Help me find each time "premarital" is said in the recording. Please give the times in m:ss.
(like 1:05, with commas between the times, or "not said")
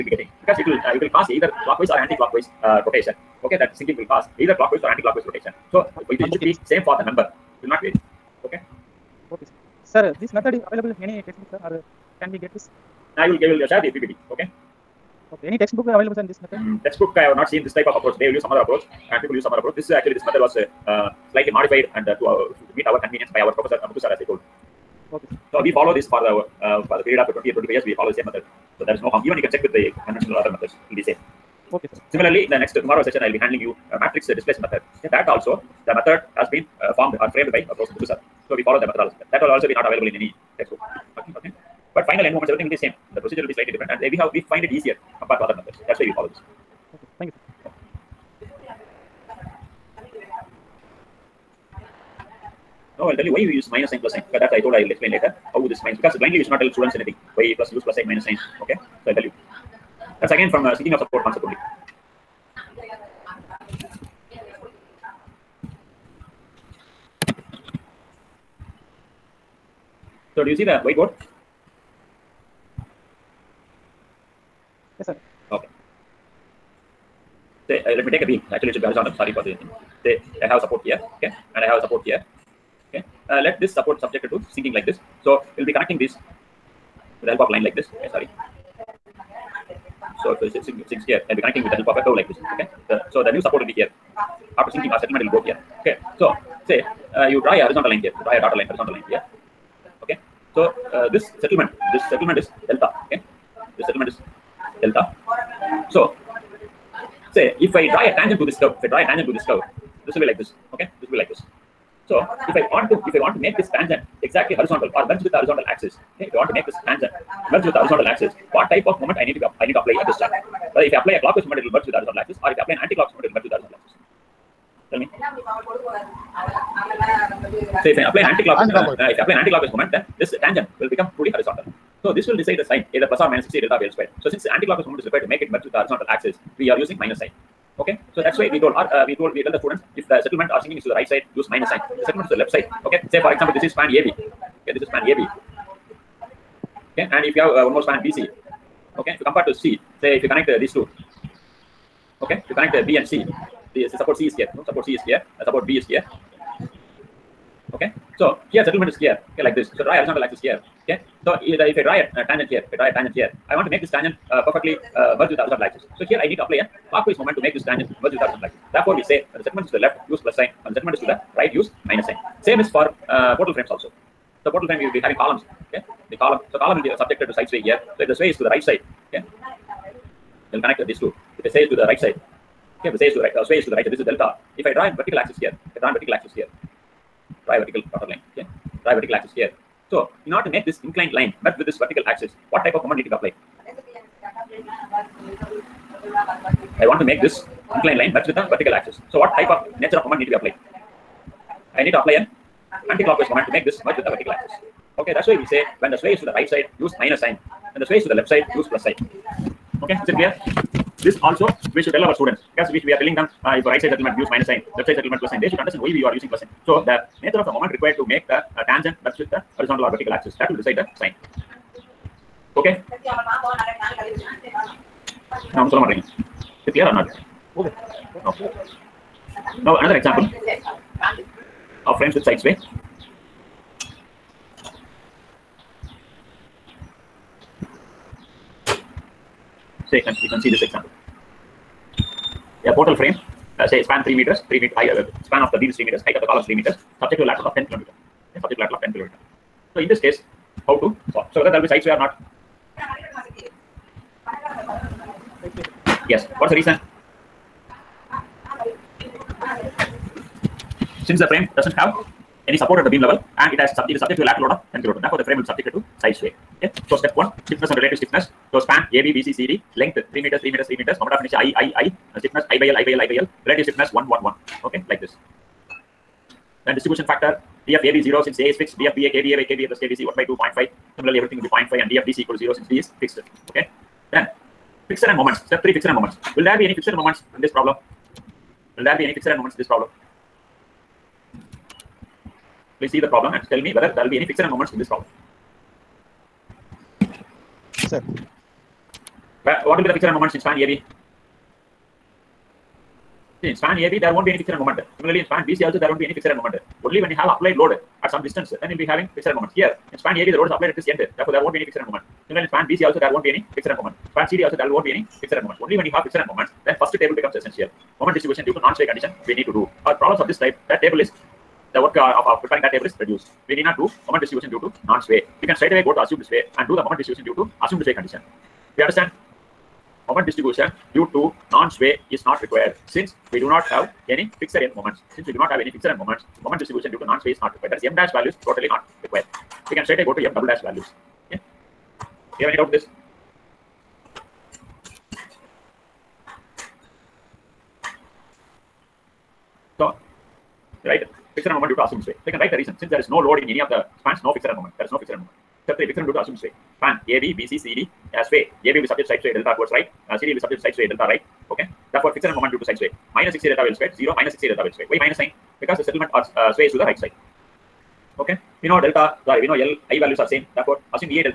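not said.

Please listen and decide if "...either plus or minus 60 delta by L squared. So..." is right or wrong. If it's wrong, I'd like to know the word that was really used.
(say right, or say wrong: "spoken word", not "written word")
right.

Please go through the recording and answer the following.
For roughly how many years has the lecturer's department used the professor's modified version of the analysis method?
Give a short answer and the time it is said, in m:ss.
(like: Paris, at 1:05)
20 or 25 years, at 0:27.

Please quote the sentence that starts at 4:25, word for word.
Therefore, the frame will be subjected to side sway.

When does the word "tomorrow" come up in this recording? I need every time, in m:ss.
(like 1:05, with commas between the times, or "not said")
0:32.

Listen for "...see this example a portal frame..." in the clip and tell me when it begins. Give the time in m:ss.
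4:00.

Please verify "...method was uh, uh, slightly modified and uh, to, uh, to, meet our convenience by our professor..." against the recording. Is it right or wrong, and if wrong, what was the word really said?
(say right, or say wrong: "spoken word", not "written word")
right.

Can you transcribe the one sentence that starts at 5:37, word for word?
That is m dash values totally not required.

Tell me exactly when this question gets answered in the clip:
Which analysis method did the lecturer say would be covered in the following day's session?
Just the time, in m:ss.
0:33.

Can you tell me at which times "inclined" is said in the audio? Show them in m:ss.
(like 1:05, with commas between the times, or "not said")
3:10, 3:17.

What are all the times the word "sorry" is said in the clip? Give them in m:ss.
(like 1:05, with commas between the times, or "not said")
1:19, 1:28, 6:09.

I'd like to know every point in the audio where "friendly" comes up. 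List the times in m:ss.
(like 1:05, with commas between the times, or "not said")
not said.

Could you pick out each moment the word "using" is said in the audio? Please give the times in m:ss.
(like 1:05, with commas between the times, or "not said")
2:16, 3:36.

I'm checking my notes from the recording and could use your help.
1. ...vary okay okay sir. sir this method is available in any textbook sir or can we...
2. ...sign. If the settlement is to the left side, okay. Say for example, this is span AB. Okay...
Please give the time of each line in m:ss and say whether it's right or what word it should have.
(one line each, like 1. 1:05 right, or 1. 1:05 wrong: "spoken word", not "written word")
1. 0:07 right
2. 2:21 right.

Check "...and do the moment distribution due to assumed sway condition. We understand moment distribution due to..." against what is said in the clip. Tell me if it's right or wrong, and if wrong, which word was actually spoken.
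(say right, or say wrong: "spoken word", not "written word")
right.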